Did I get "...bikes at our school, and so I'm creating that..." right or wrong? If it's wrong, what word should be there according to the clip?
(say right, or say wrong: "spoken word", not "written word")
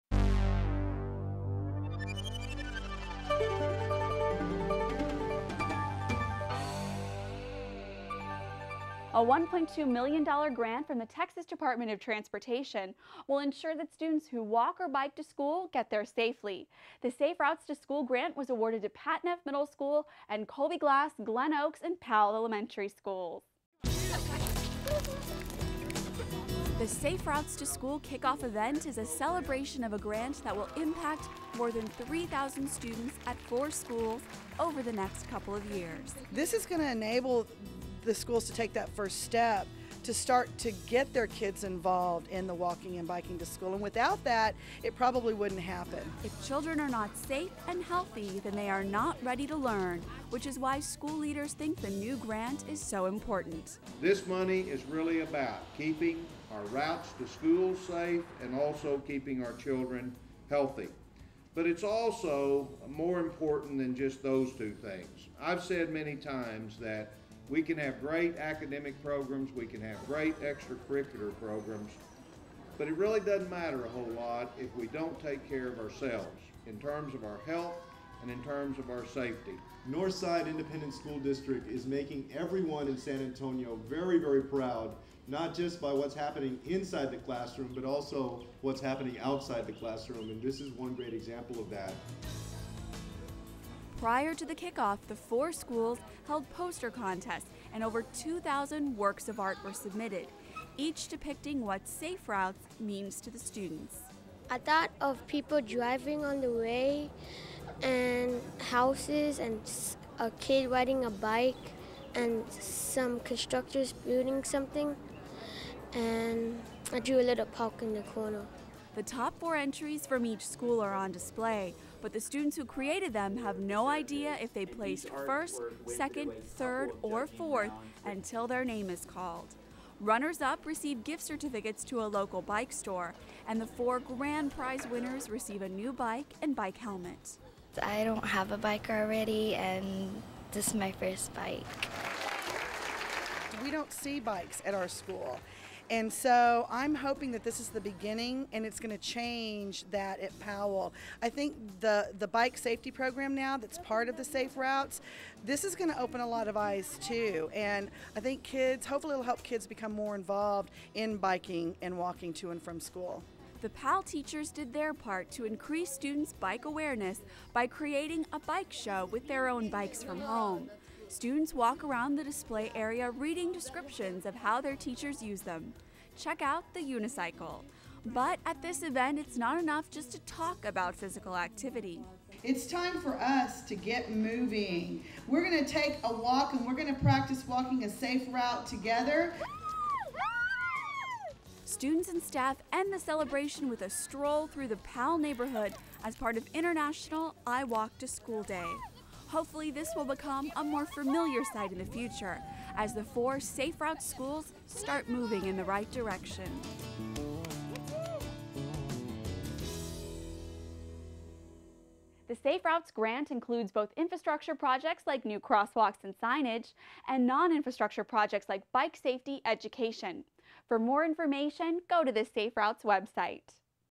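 wrong: "hoping", not "creating".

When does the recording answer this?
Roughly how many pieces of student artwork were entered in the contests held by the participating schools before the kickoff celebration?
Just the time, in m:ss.
1:38.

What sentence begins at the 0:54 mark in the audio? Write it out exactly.
This money is really about keeping our routes to school safe and also keeping our children healthy.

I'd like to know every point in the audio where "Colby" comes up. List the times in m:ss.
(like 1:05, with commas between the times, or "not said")
0:20.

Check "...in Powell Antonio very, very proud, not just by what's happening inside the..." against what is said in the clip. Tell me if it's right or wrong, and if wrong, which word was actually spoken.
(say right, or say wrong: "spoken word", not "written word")
wrong: "San", not "Powell".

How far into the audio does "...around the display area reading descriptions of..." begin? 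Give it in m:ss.
2:51.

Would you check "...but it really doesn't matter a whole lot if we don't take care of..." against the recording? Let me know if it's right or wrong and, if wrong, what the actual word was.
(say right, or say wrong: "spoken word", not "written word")
right.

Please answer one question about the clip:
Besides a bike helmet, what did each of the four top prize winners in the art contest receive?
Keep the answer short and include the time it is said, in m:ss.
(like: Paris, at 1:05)
A new bike, at 2:15.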